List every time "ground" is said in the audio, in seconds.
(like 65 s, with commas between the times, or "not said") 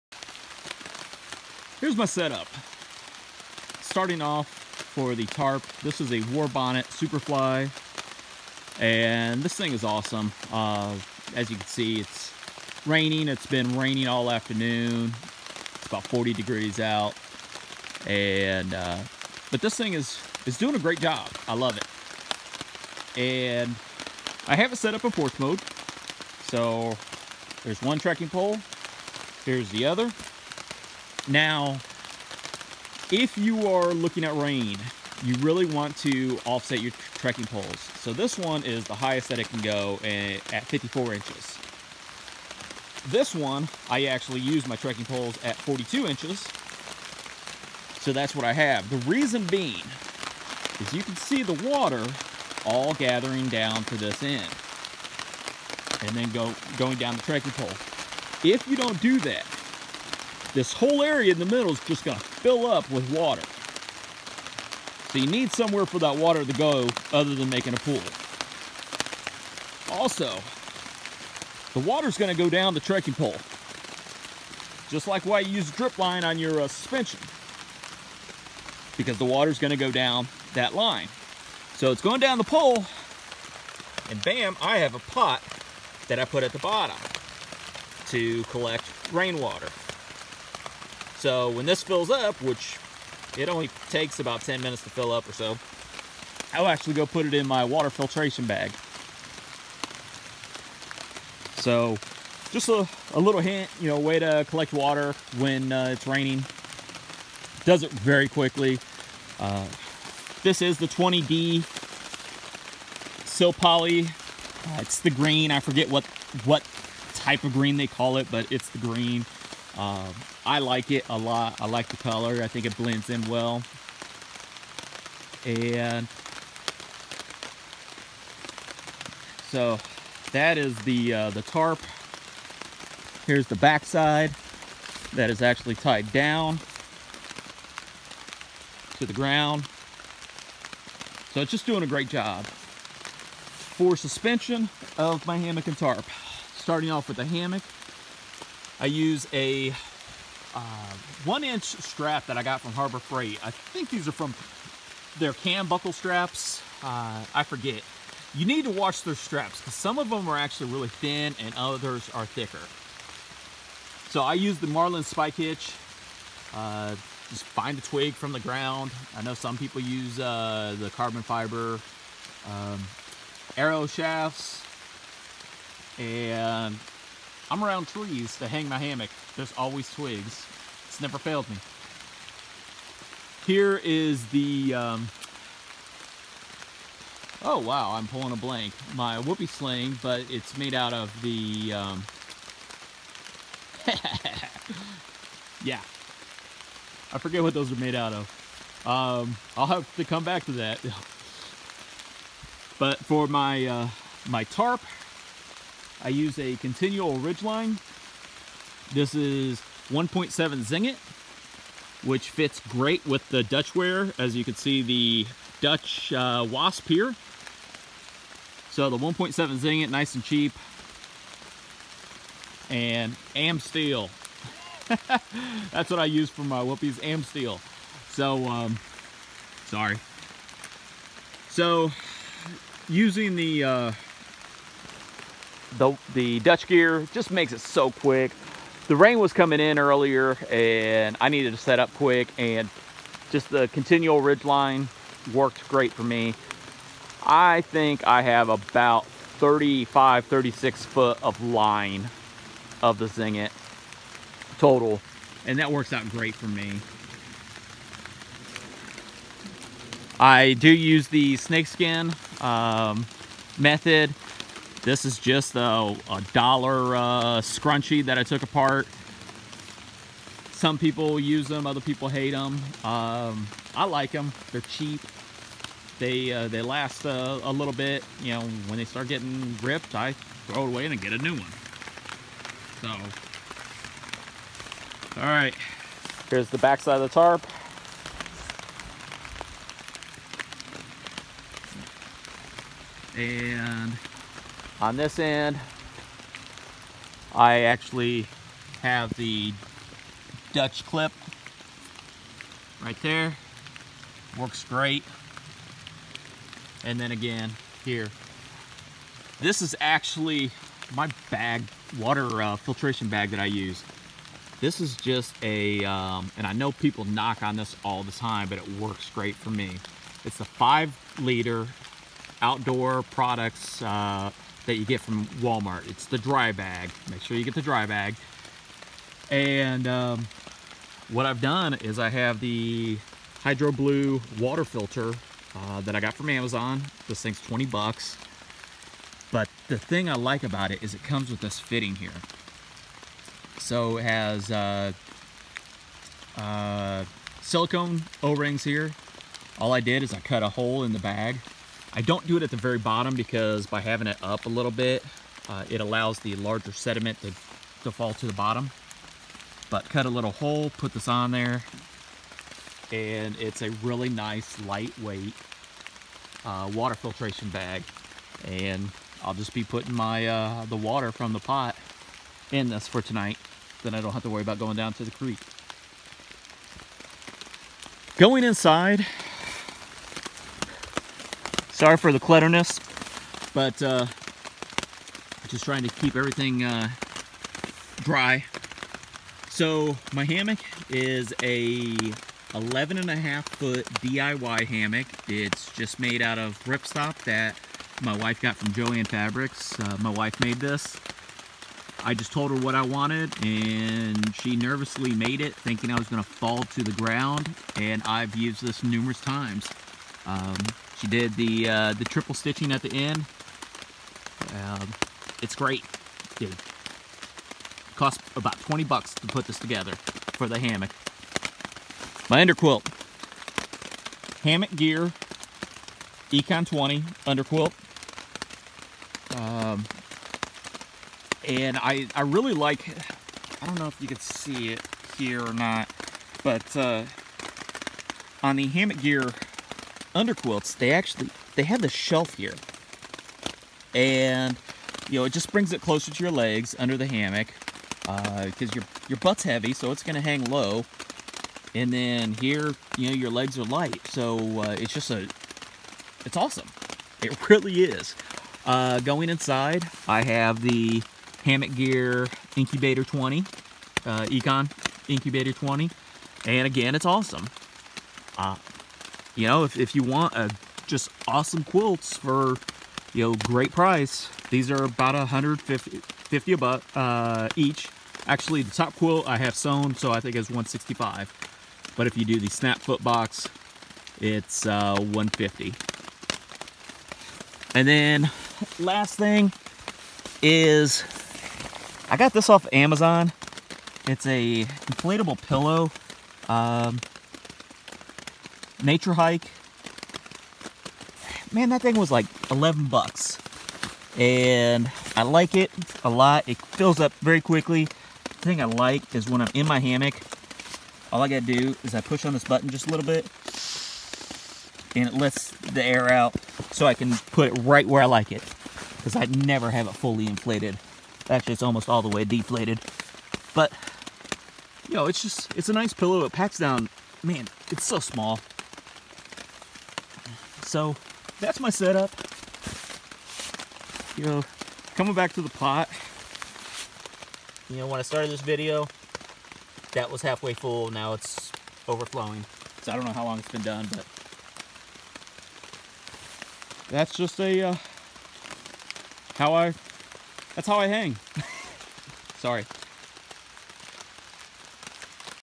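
139 s, 168 s, 406 s.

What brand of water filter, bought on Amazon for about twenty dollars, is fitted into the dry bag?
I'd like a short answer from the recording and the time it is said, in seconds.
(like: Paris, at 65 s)
HydroBlu, at 333 s.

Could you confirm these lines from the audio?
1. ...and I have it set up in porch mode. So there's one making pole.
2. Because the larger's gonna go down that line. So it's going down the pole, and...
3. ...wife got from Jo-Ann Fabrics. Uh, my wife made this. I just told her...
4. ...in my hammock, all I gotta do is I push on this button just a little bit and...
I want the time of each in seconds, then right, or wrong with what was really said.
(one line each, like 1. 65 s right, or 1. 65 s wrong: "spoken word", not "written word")
1. 23 s wrong: "trekking", not "making"
2. 78 s wrong: "water", not "larger"
3. 398 s right
4. 509 s right.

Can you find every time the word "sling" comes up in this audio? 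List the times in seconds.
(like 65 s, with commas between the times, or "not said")
189 s.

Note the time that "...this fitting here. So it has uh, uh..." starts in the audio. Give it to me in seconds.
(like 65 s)
341 s.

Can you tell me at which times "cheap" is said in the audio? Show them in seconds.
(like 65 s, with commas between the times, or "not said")
220 s, 274 s.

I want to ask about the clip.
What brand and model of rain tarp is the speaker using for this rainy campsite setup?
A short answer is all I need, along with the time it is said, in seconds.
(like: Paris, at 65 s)
Warbonnet Superfly, at 6 s.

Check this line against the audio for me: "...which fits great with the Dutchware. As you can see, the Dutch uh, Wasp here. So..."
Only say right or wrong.
right.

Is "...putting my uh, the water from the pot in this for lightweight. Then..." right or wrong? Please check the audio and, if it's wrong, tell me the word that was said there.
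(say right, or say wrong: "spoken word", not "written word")
wrong: "tonight", not "lightweight".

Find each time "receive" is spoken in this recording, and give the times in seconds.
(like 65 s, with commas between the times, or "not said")
not said.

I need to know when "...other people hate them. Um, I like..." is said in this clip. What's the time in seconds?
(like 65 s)
271 s.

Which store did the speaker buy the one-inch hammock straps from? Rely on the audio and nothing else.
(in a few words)
Harbor Freight.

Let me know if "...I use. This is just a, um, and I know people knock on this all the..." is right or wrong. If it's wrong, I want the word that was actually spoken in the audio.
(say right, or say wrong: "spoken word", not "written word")
right.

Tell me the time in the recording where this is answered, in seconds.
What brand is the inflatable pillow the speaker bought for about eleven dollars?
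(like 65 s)
498 s.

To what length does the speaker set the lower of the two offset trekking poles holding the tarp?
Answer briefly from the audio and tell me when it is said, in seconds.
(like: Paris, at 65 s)
42 inches, at 45 s.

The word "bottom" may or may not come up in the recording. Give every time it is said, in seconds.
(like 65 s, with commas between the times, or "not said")
86 s, 352 s, 358 s.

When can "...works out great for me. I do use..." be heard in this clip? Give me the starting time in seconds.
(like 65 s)
255 s.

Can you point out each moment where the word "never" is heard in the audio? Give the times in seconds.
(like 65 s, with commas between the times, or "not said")
181 s, 519 s.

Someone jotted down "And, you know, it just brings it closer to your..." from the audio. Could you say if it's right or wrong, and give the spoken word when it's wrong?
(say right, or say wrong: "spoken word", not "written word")
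right.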